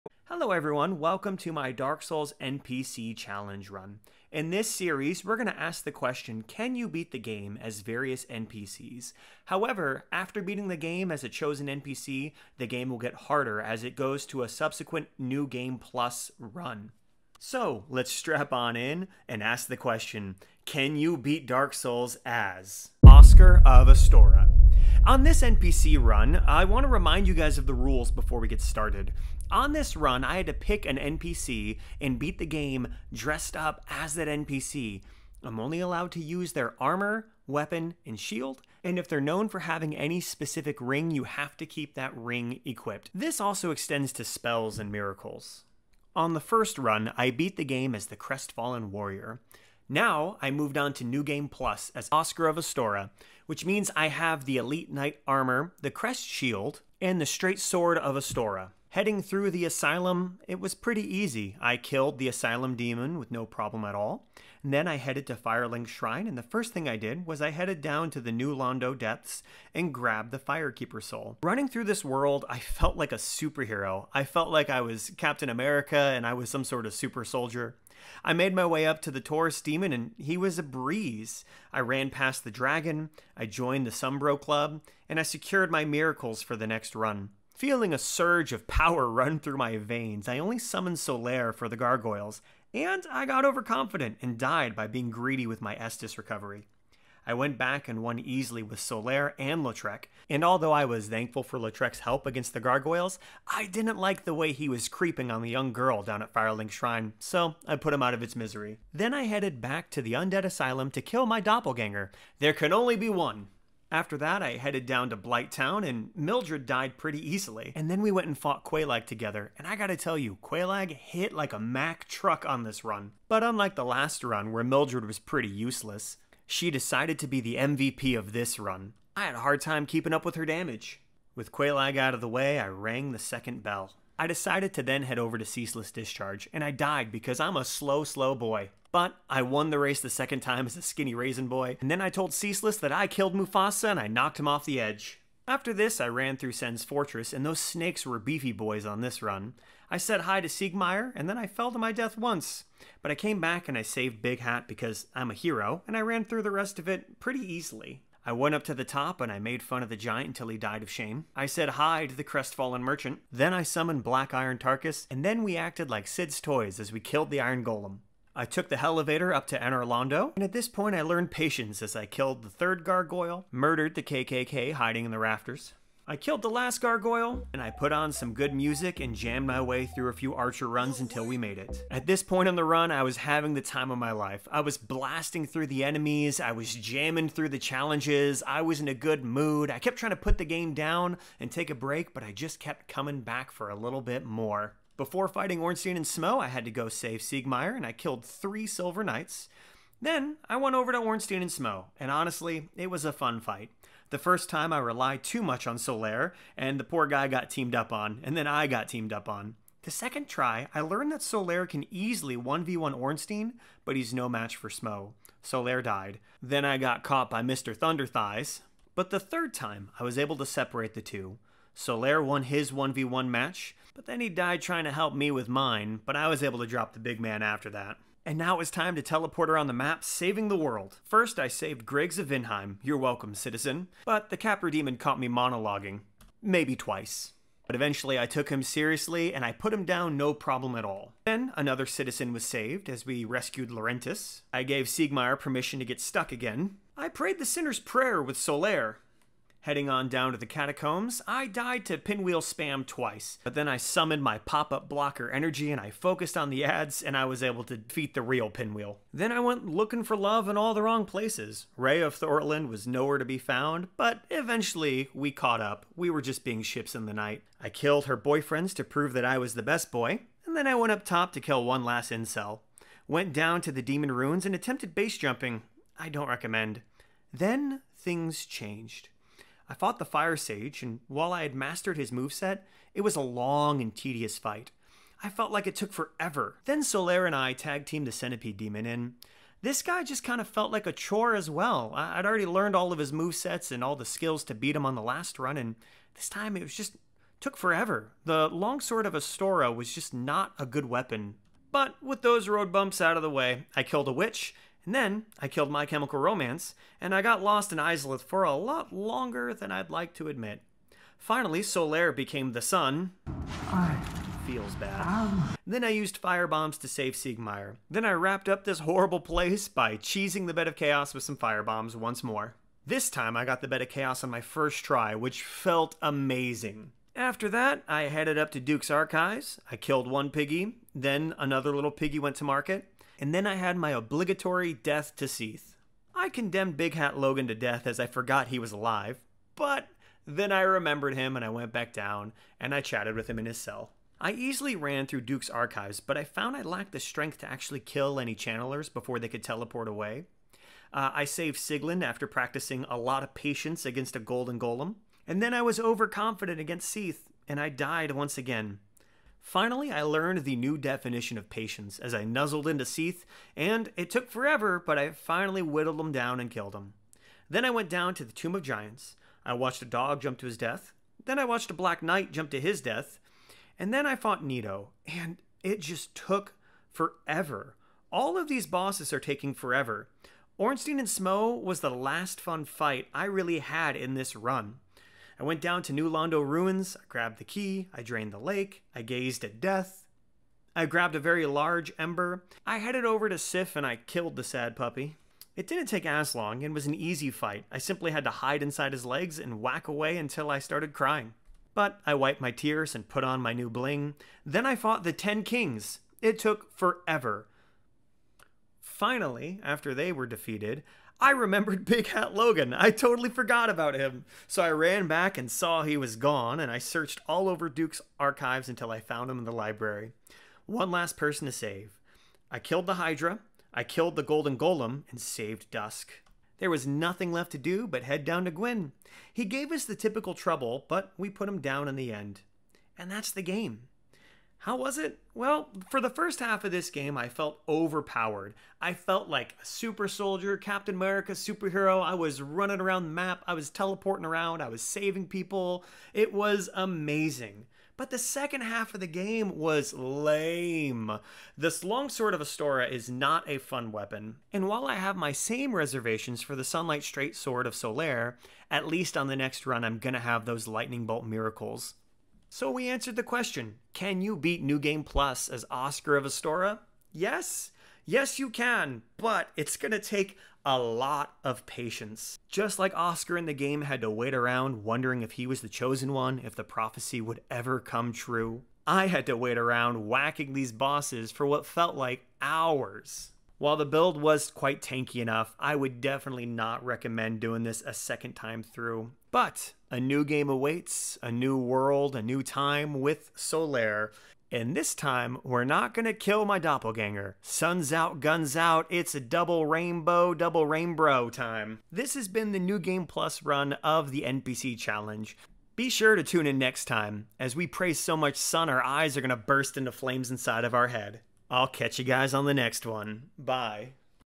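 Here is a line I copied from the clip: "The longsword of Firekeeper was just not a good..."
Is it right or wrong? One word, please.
wrong.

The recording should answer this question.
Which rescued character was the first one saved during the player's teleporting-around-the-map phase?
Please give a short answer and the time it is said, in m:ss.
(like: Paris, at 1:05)
Griggs of Vinheim, at 3:51.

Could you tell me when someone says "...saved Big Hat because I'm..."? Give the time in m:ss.
2:33.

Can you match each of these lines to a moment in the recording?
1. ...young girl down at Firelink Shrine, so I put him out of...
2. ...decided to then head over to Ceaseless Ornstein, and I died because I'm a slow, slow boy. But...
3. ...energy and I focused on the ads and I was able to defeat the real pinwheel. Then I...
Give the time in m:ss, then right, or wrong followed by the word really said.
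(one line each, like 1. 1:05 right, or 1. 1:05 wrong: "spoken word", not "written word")
1. 1:45 right
2. 2:14 wrong: "Discharge", not "Ornstein"
3. 4:15 right.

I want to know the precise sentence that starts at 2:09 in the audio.
I had a hard time keeping up with her damage.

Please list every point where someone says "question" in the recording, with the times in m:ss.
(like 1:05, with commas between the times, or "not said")
0:05, 0:19, 7:43.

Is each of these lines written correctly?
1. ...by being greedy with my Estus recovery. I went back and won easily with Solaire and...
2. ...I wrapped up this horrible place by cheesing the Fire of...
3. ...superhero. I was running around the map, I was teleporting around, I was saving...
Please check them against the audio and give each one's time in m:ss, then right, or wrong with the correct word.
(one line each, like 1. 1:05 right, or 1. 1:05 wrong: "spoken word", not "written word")
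1. 1:34 right
2. 5:18 wrong: "Bed", not "Fire"
3. 7:21 right.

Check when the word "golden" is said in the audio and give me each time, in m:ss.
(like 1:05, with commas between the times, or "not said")
5:54, 7:04.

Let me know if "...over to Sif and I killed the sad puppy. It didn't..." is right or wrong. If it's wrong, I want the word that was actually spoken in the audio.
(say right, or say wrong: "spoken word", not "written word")
right.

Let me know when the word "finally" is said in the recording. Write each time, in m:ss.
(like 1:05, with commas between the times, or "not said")
5:11, 5:59, 6:05, 6:48.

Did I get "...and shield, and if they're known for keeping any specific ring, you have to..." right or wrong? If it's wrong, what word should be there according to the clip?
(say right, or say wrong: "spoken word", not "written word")
wrong: "having", not "keeping".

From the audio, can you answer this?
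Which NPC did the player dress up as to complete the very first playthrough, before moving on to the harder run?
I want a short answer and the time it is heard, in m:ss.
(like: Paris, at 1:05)
Crestfallen Warrior, at 0:48.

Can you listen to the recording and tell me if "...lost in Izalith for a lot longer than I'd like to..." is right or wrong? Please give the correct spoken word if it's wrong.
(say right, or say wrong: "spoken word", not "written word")
right.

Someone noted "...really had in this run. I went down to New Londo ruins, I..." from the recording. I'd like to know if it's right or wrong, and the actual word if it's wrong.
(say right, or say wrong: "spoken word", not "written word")
right.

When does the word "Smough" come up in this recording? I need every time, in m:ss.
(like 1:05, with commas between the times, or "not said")
3:16, 3:21, 3:34, 6:21.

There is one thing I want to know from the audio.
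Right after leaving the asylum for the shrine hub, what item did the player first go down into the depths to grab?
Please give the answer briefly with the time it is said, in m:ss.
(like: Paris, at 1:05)
Firekeeper Soul, at 1:10.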